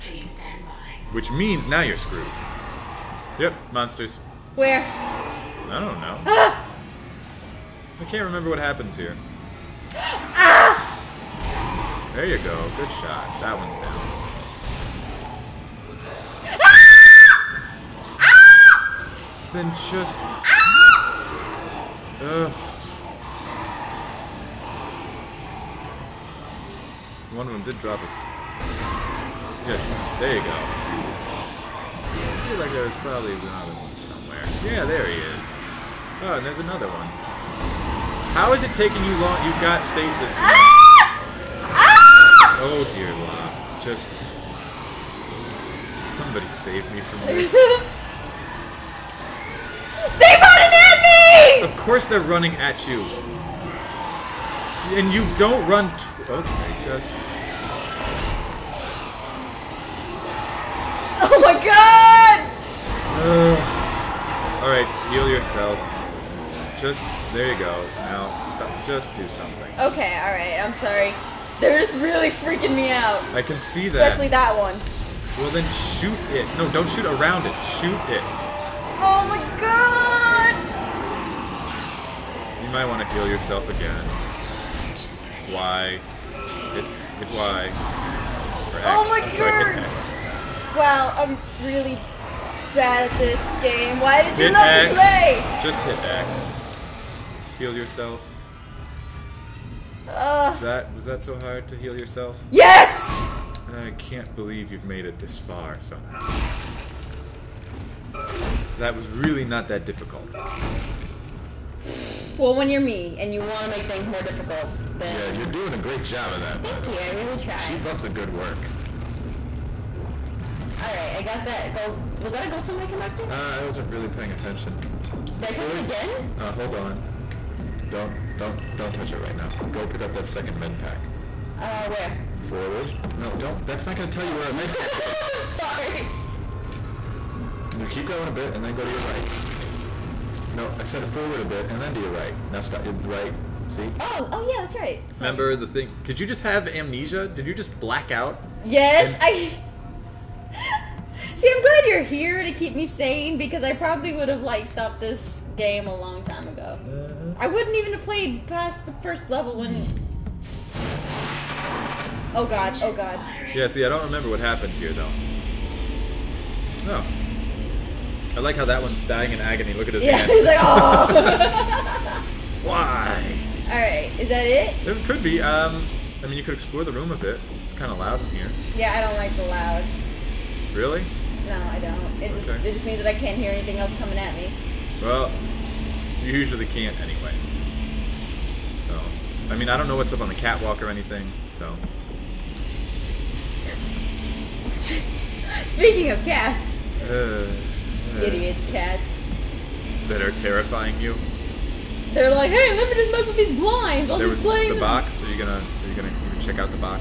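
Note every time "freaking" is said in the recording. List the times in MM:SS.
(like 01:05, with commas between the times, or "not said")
01:12.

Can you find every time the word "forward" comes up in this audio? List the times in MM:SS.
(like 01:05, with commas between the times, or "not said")
02:12, 02:21.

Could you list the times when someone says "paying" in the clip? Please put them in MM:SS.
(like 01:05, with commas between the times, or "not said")
02:04.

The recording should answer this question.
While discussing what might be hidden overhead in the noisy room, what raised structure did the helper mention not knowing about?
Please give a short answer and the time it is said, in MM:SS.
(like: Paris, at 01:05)
Catwalk, at 03:10.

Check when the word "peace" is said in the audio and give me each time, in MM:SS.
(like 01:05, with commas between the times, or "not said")
not said.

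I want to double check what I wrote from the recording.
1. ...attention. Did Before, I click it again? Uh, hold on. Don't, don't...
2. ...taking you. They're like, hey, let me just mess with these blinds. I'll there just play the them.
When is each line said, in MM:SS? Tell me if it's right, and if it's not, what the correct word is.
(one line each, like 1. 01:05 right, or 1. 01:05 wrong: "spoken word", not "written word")
1. 02:04 right
2. 03:20 wrong: "terrifying", not "taking".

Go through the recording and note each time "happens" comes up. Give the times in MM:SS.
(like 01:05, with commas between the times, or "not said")
00:08, 02:44.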